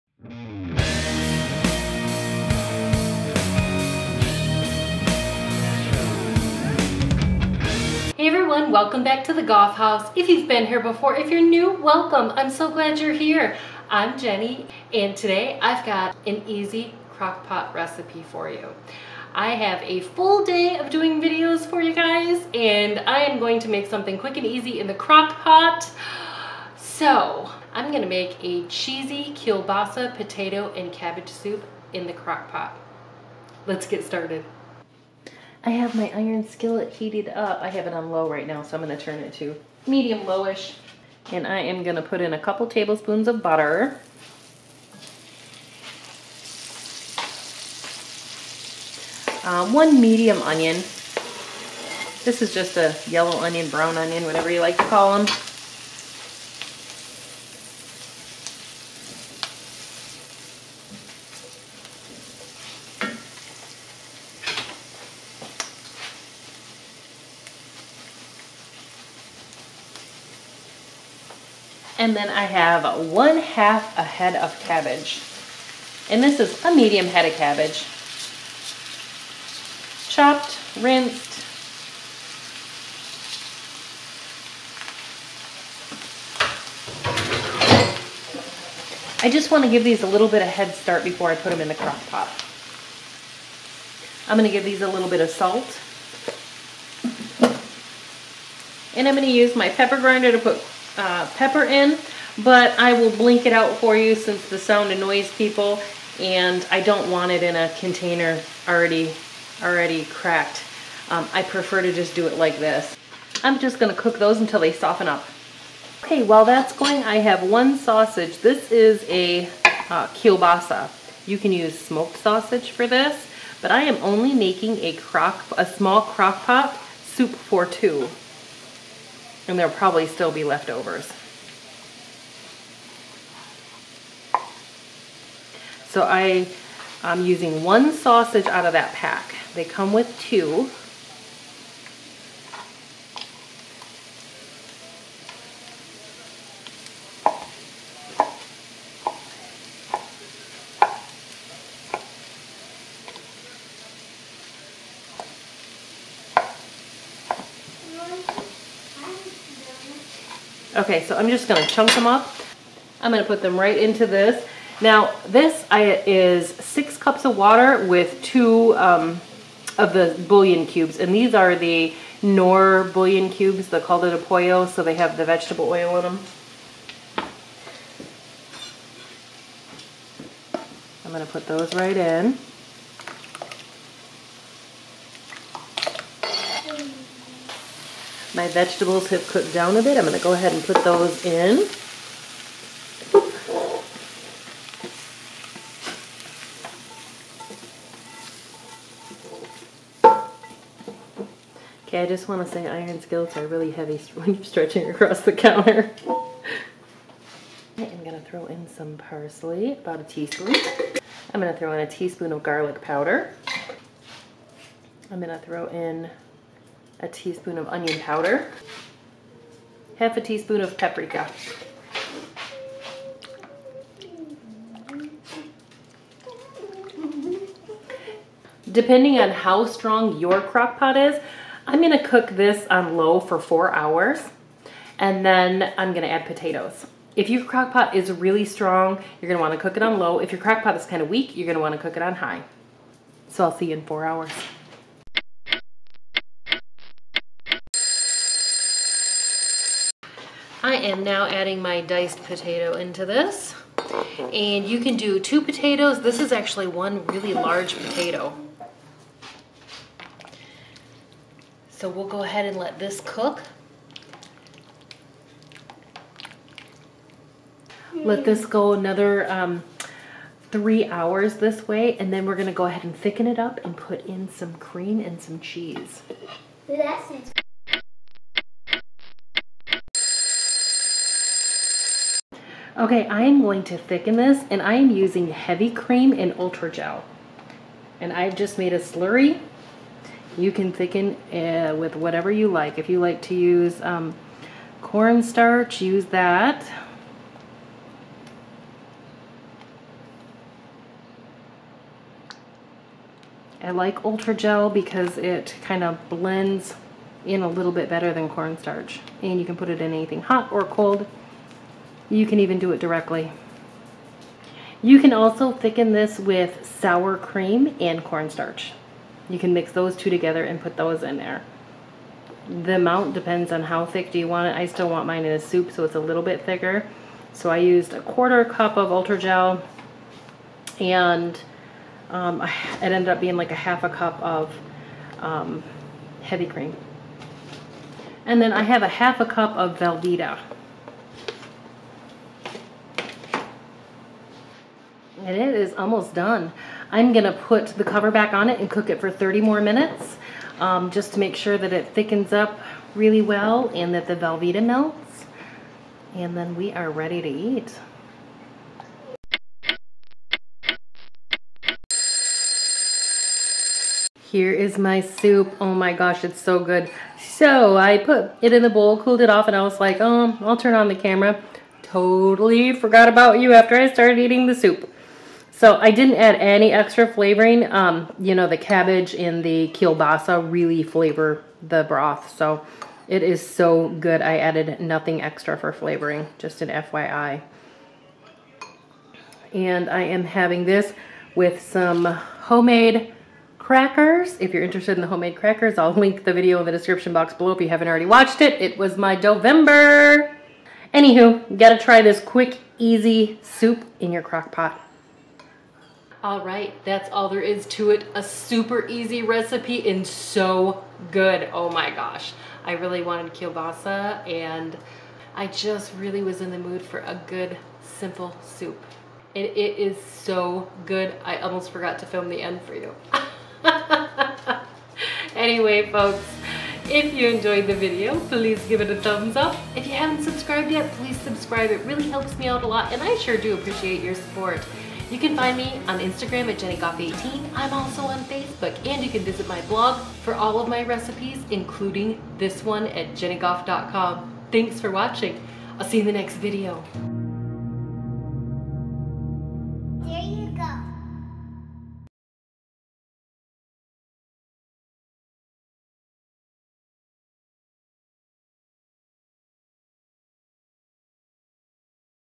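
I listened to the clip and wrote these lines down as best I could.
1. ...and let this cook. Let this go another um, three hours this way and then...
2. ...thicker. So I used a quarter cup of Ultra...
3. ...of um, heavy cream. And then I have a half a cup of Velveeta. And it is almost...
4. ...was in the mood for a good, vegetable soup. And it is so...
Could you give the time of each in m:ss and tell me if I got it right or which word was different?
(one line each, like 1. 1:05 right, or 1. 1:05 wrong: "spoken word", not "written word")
1. 4:22 right
2. 5:26 right
3. 5:34 right
4. 6:56 wrong: "simple", not "vegetable".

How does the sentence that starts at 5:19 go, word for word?
You can mix those two together and put those in there.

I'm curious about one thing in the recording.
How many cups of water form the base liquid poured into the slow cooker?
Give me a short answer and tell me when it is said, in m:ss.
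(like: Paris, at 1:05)
6, at 2:46.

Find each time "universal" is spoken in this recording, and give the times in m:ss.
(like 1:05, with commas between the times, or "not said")
not said.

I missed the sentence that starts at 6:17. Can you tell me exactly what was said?
Um, you know, the cabbage and the kielbasa really flavor the broth.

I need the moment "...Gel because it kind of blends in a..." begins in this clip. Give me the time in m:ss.
5:04.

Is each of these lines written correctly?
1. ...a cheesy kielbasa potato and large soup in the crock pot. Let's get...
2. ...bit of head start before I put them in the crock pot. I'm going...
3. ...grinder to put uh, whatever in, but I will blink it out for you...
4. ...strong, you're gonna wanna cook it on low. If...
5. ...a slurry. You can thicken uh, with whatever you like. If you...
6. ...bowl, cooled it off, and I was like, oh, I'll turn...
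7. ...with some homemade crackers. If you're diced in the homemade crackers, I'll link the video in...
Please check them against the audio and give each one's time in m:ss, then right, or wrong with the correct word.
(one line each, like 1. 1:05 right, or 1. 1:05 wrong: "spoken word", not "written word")
1. 0:28 wrong: "cabbage", not "large"
2. 1:30 right
3. 1:39 wrong: "pepper", not "whatever"
4. 3:58 right
5. 4:48 right
6. 6:08 right
7. 6:31 wrong: "interested", not "diced".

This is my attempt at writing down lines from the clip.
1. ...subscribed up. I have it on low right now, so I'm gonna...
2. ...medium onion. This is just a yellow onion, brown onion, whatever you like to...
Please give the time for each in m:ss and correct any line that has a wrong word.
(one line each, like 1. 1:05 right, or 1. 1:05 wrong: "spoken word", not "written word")
1. 0:36 wrong: "heated", not "subscribed"
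2. 0:50 right.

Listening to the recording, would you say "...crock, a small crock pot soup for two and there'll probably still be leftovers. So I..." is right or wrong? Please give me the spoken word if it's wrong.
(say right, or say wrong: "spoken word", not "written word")
right.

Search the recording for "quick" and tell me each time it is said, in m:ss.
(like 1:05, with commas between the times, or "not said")
0:24, 6:42.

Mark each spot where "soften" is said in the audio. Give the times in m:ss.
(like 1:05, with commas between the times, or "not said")
1:54.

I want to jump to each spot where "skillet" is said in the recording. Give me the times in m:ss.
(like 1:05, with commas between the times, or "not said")
0:36, 3:23.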